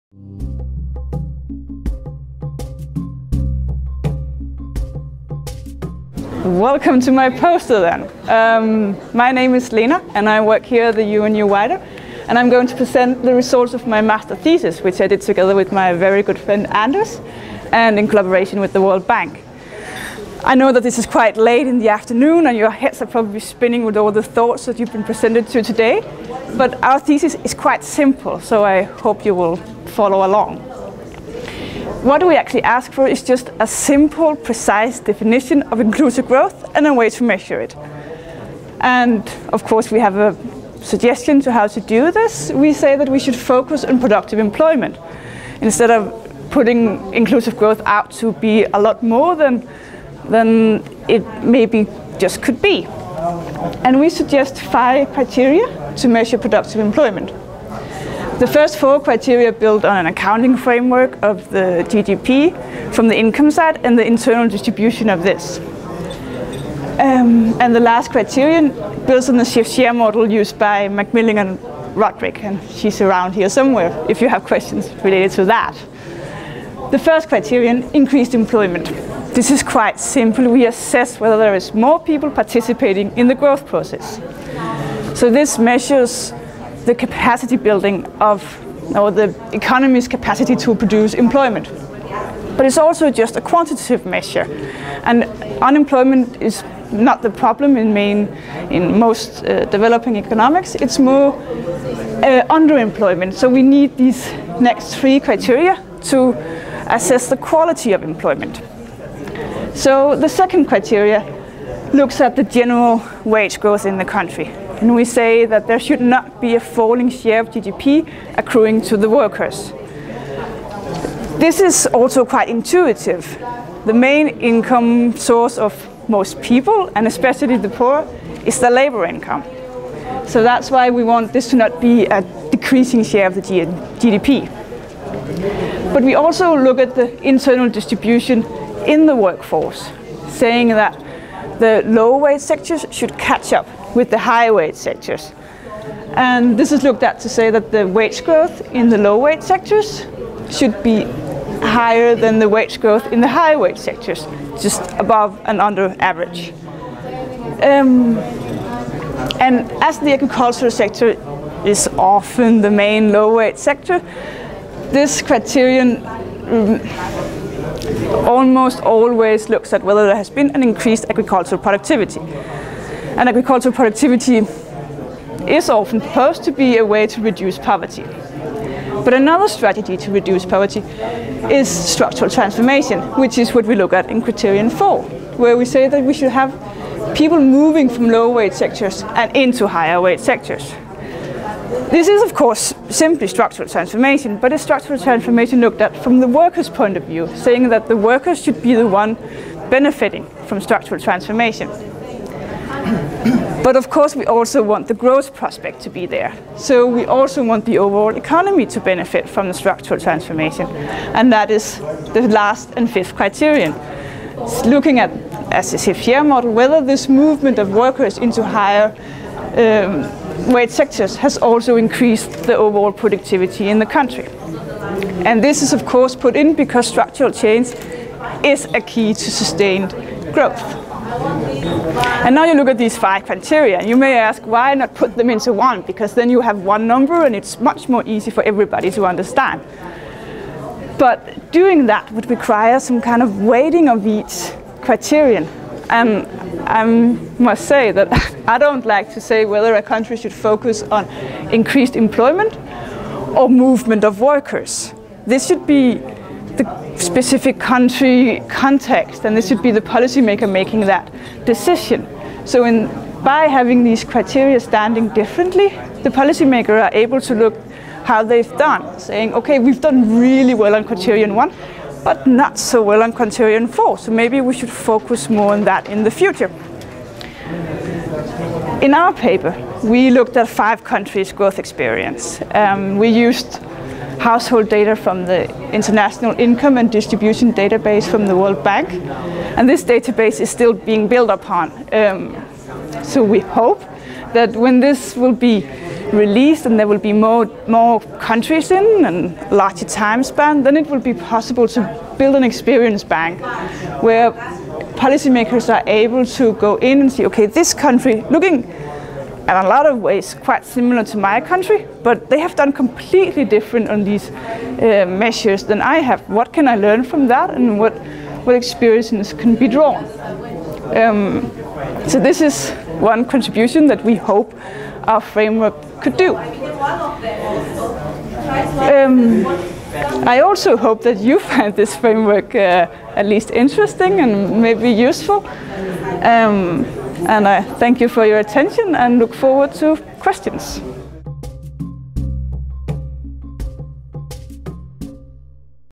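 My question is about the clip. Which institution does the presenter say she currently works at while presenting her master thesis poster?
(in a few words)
UNU WIDER.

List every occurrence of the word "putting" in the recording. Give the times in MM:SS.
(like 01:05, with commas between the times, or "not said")
00:46.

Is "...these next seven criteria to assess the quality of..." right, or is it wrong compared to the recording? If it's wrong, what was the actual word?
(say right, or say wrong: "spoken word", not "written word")
wrong: "three", not "seven".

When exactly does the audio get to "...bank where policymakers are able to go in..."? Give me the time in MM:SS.
05:03.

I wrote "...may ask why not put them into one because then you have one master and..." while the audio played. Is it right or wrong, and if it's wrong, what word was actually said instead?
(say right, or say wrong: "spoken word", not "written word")
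wrong: "number", not "master".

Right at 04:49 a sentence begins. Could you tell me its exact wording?
And this database is still being built upon.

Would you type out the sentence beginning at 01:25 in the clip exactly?
So this measures the capacity building of or the economy's capacity to produce employment.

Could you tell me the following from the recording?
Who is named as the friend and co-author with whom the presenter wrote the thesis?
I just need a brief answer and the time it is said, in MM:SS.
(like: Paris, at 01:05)
Anders, at 00:16.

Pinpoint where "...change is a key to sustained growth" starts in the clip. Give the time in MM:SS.
03:47.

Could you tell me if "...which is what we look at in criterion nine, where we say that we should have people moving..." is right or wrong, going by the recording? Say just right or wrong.
wrong.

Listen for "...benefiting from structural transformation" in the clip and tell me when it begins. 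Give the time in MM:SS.
03:19.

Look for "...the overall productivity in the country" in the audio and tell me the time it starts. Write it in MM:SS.
03:42.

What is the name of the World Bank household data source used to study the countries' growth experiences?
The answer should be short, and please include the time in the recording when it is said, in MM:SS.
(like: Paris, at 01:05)
International Income and Distribution Database, at 04:45.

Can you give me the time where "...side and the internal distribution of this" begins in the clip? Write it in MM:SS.
01:03.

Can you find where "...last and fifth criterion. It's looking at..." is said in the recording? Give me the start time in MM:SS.
03:32.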